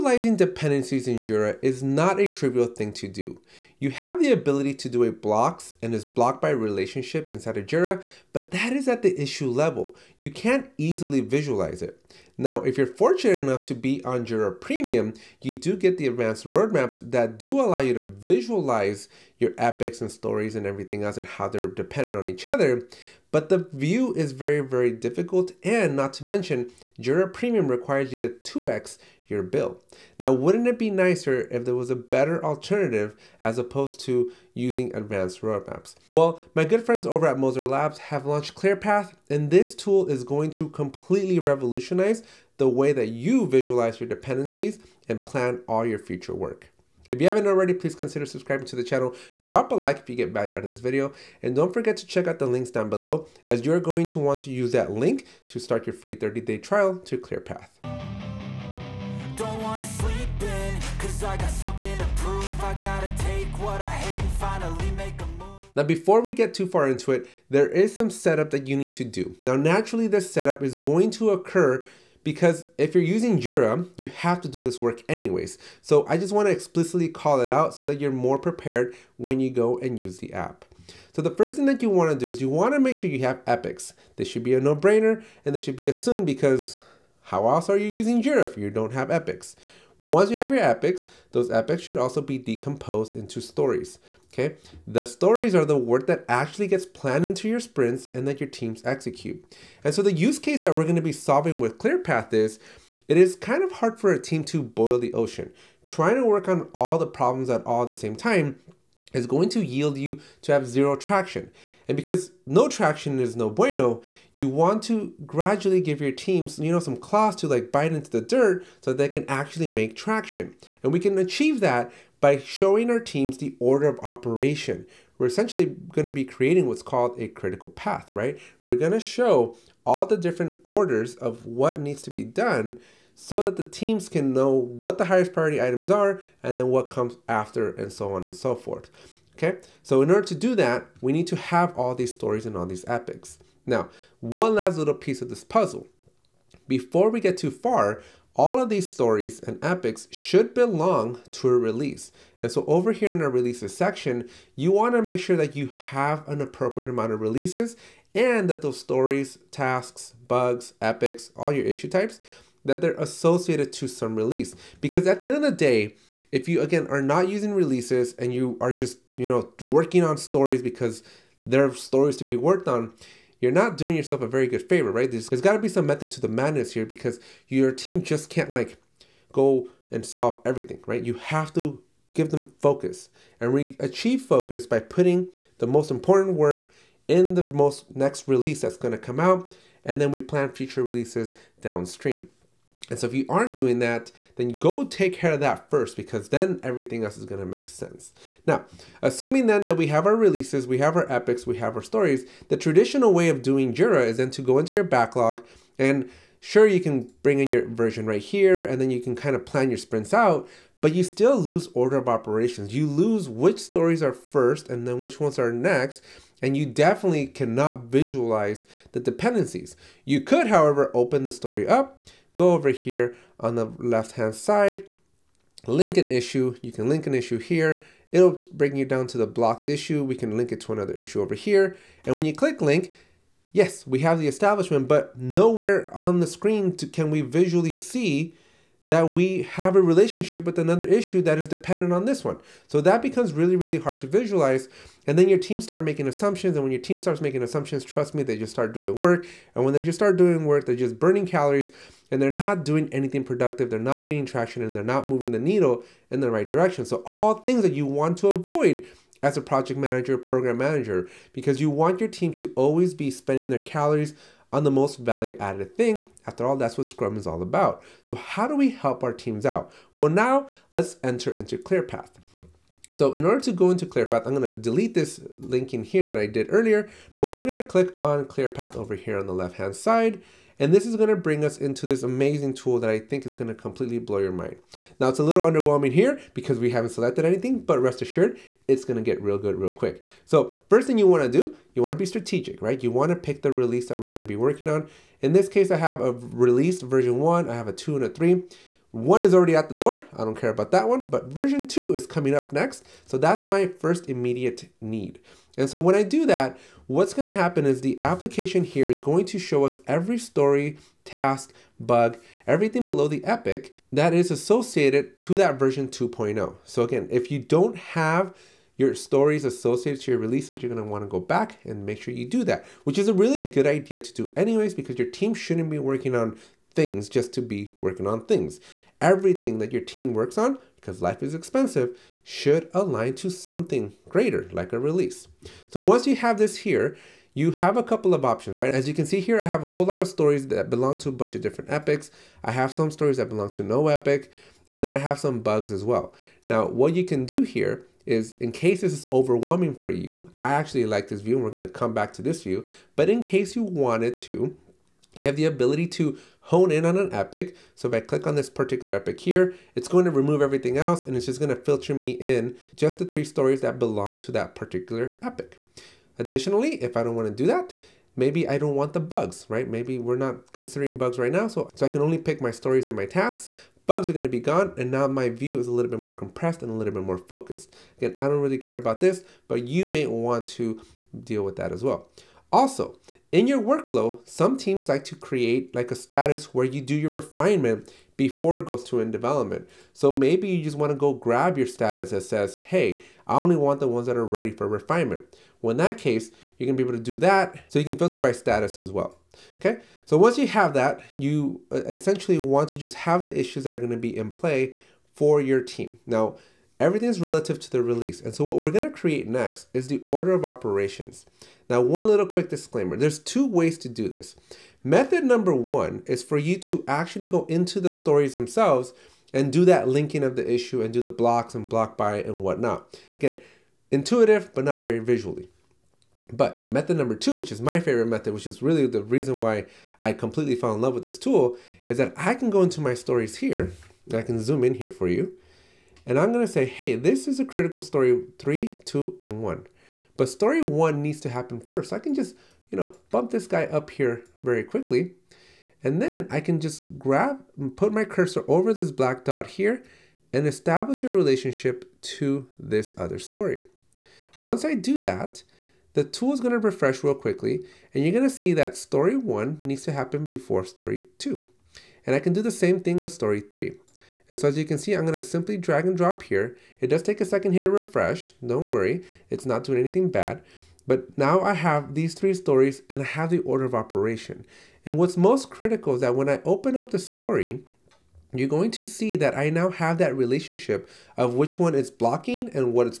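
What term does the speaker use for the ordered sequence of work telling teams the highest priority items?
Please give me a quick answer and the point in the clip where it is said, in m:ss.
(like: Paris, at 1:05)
critical path, at 2:07.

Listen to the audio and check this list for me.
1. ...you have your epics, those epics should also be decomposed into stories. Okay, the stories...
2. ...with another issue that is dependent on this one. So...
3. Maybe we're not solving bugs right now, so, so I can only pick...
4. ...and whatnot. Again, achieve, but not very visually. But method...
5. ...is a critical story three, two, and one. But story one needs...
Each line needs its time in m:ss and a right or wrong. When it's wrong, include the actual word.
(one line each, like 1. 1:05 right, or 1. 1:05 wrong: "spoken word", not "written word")
1. 1:30 right
2. 4:00 right
3. 6:09 wrong: "considering", not "solving"
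4. 7:02 wrong: "intuitive", not "achieve"
5. 7:17 right.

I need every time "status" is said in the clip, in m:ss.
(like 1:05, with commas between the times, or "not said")
6:25, 6:31, 6:38.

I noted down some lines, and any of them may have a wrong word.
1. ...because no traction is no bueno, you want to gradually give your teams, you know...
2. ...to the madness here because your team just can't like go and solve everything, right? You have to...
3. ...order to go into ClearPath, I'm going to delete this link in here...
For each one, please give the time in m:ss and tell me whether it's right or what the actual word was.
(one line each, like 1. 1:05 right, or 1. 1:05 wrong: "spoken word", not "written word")
1. 1:51 right
2. 2:56 right
3. 4:33 right.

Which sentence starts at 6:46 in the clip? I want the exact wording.
Now, Everything's relative to the release.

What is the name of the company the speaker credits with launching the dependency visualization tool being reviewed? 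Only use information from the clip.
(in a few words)
Moser Labs.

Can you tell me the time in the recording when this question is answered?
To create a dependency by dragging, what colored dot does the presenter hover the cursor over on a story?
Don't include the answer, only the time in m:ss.
7:28.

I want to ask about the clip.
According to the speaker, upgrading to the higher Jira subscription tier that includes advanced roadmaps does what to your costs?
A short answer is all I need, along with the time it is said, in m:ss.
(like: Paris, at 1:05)
2x your bill, at 0:28.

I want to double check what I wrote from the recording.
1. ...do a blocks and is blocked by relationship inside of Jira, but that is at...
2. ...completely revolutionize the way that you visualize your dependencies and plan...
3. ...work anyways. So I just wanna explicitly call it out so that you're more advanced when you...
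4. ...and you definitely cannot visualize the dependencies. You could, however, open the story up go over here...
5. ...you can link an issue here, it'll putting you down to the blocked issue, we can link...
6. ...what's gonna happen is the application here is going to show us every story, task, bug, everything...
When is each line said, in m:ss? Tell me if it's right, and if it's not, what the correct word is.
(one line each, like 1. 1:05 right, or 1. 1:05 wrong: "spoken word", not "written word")
1. 0:04 right
2. 0:40 right
3. 1:14 wrong: "prepared", not "advanced"
4. 3:36 right
5. 3:46 wrong: "bring", not "putting"
6. 5:06 right.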